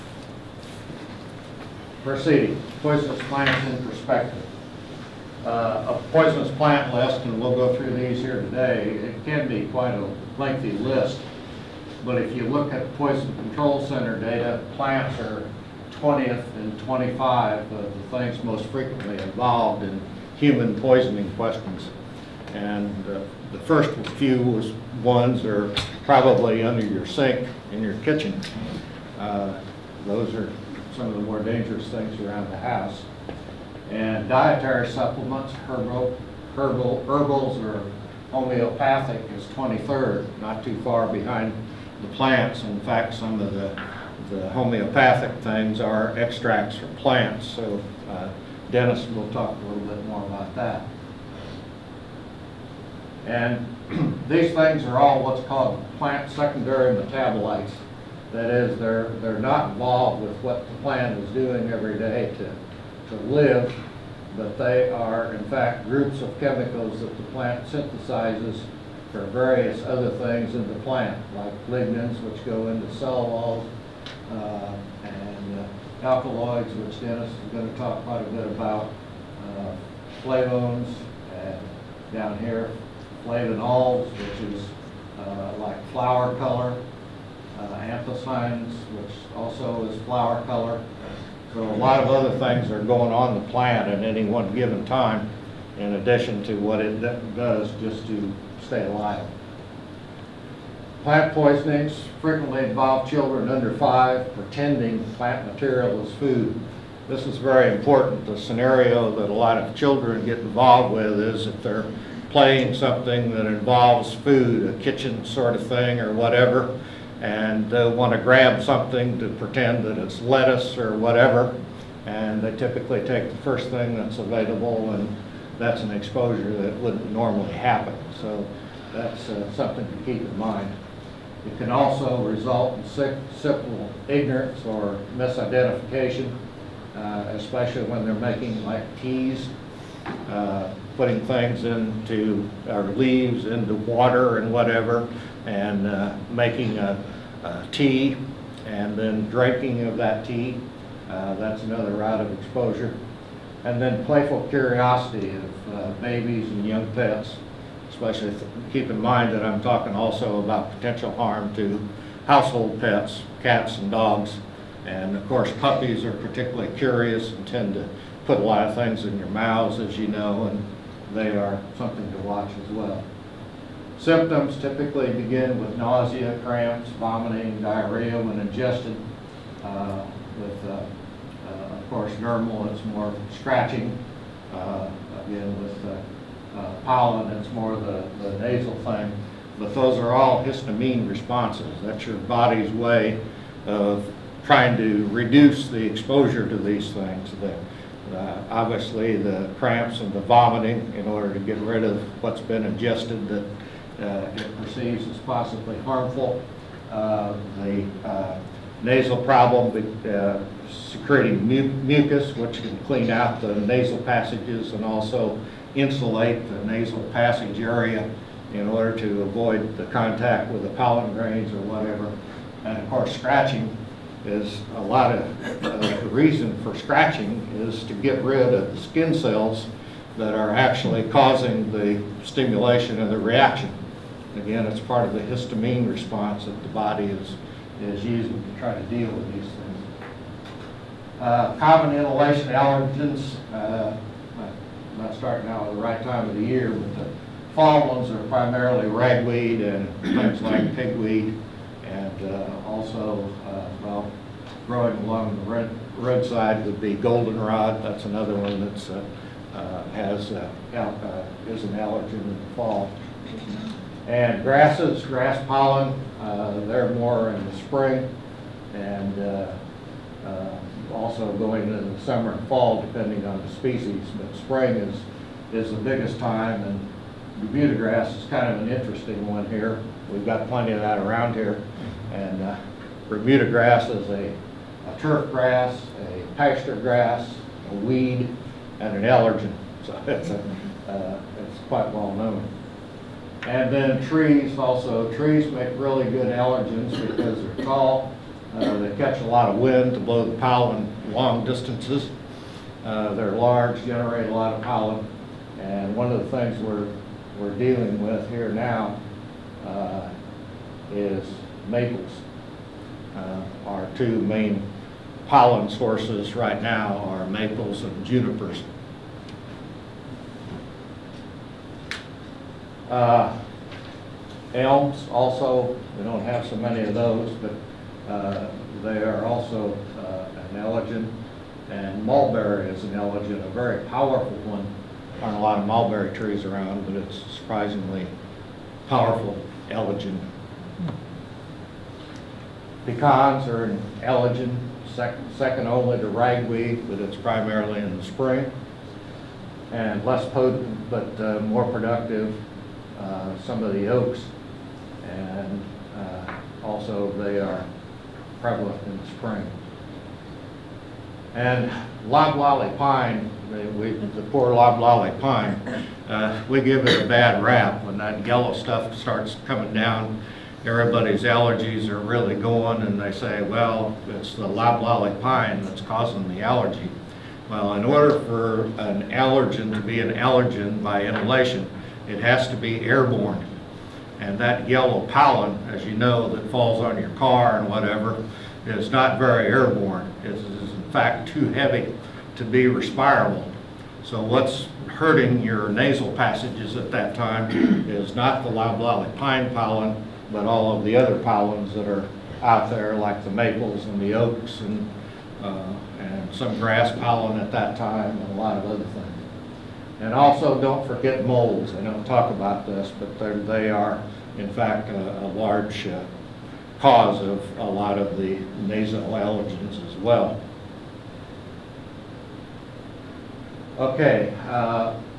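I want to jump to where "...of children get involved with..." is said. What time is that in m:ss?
1:49.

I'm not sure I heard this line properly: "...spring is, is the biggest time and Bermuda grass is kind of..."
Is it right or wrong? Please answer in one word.
right.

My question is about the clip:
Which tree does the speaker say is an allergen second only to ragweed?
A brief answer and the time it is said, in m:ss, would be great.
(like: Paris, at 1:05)
Pecans, at 5:42.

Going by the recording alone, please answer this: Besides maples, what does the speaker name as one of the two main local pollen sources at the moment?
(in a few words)
junipers.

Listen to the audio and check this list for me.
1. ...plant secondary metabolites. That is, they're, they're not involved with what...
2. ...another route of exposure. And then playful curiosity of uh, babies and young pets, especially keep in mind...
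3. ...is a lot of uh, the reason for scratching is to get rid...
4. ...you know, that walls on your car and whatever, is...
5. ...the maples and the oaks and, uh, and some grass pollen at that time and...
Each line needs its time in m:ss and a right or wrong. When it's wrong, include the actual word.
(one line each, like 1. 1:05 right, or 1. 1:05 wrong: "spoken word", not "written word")
1. 0:55 right
2. 2:31 right
3. 3:44 right
4. 6:25 wrong: "falls", not "walls"
5. 6:43 right.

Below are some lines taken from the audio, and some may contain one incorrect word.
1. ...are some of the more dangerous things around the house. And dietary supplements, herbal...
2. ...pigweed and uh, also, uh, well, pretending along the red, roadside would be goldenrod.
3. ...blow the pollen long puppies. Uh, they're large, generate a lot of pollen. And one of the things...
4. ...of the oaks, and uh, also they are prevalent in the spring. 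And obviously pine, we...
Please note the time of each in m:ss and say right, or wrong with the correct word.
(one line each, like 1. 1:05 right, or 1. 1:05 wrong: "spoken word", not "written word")
1. 0:30 right
2. 4:10 wrong: "growing", not "pretending"
3. 4:59 wrong: "distances", not "puppies"
4. 5:53 wrong: "loblolly", not "obviously".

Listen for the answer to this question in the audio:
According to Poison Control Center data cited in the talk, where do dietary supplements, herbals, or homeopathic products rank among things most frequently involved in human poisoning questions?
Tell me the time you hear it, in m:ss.
0:39.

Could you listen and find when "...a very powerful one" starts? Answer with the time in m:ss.
5:33.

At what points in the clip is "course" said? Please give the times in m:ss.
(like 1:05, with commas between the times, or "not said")
2:45, 3:01, 3:42.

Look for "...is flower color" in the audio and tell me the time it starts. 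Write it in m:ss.
1:29.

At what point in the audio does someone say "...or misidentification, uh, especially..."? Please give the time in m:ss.
2:14.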